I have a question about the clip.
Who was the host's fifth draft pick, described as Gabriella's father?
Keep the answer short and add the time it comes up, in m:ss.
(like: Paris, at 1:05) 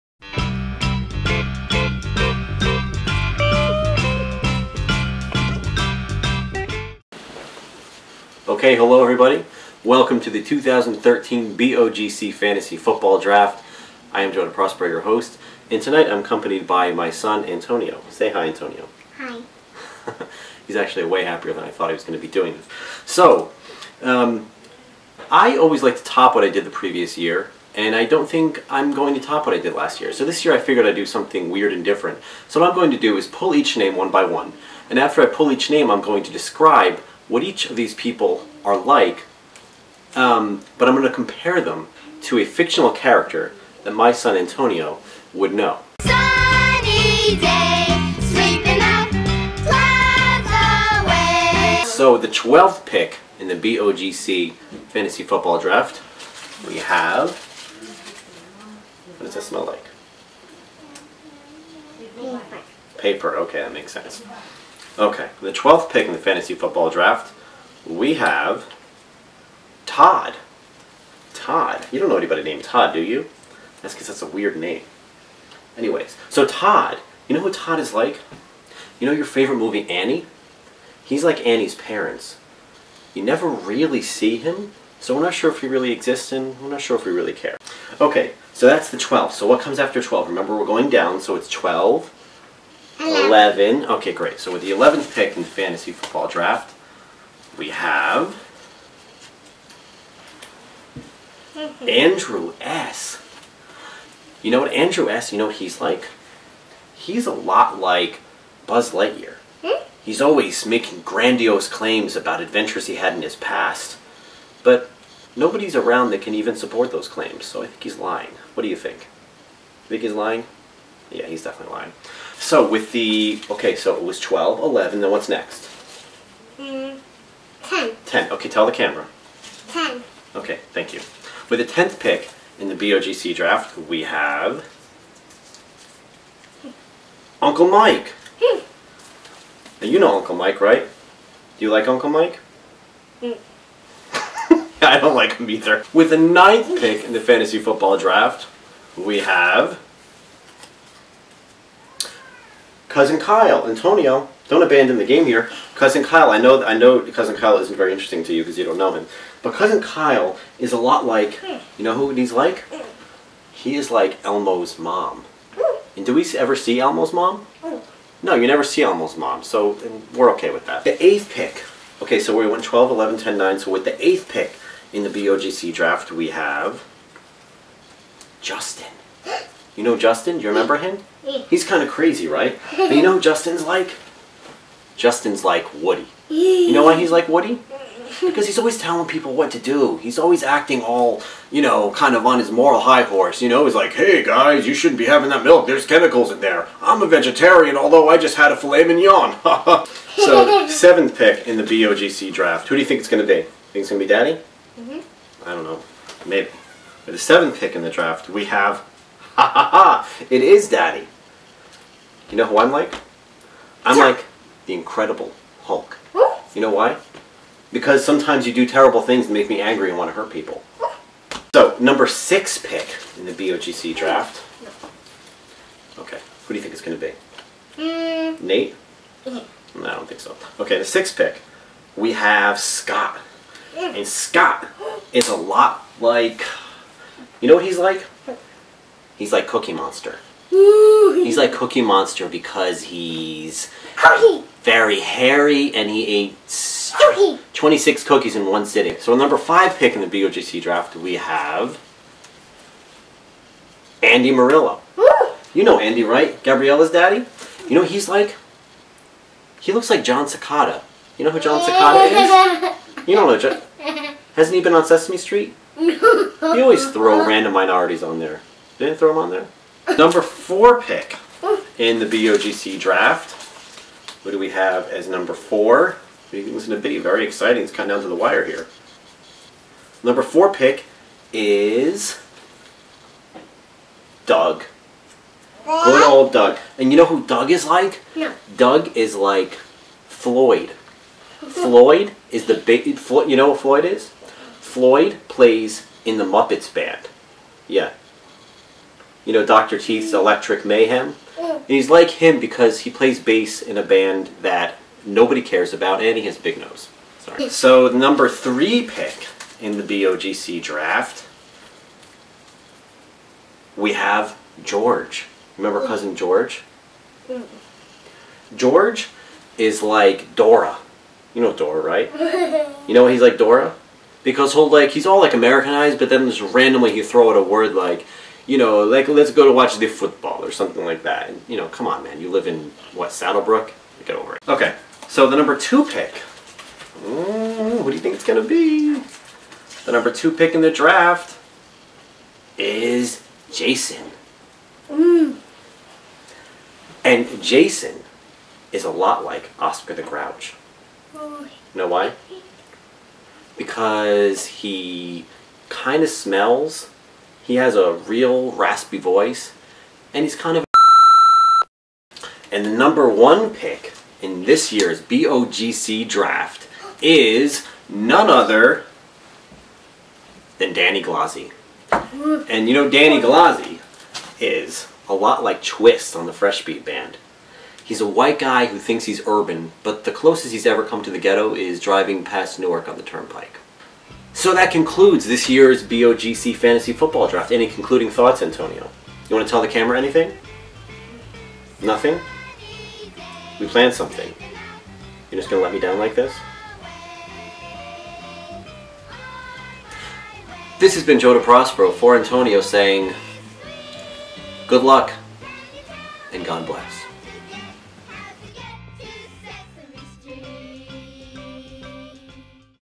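Andy Murillo, at 4:14.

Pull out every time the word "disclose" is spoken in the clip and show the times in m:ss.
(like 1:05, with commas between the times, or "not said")
not said.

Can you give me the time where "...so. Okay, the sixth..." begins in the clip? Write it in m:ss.
3:50.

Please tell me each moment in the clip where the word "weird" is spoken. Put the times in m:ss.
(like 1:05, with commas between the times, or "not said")
0:31, 1:14.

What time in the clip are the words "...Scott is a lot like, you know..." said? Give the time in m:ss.
3:54.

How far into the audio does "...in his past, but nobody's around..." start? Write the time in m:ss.
1:53.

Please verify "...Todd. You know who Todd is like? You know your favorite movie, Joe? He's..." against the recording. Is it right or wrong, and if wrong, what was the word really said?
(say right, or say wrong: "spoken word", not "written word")
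wrong: "Annie", not "Joe".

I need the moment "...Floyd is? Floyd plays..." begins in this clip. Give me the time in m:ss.
4:53.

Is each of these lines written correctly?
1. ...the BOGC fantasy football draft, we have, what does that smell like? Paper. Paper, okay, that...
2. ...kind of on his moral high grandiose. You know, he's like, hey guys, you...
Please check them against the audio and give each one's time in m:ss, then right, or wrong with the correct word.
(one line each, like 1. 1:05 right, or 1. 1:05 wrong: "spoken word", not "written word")
1. 0:53 right
2. 3:11 wrong: "horse", not "grandiose".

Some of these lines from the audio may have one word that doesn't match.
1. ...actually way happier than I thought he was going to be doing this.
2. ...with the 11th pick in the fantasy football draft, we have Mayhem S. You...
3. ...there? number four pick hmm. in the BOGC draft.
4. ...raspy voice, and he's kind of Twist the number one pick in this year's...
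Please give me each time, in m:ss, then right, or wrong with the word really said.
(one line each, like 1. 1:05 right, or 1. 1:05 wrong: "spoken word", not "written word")
1. 0:20 right
2. 1:34 wrong: "Andrew", not "Mayhem"
3. 4:29 right
4. 5:58 wrong: "And", not "Twist".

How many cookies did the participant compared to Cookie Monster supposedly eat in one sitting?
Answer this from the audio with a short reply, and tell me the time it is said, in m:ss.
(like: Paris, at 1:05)
26, at 4:07.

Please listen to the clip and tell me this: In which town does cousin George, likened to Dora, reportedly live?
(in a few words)
Saddle Brook.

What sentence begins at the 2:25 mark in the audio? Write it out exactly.
With the ninth pick in the fantasy football draft, we have cousin Kyle, Antonio don't abandon the game here.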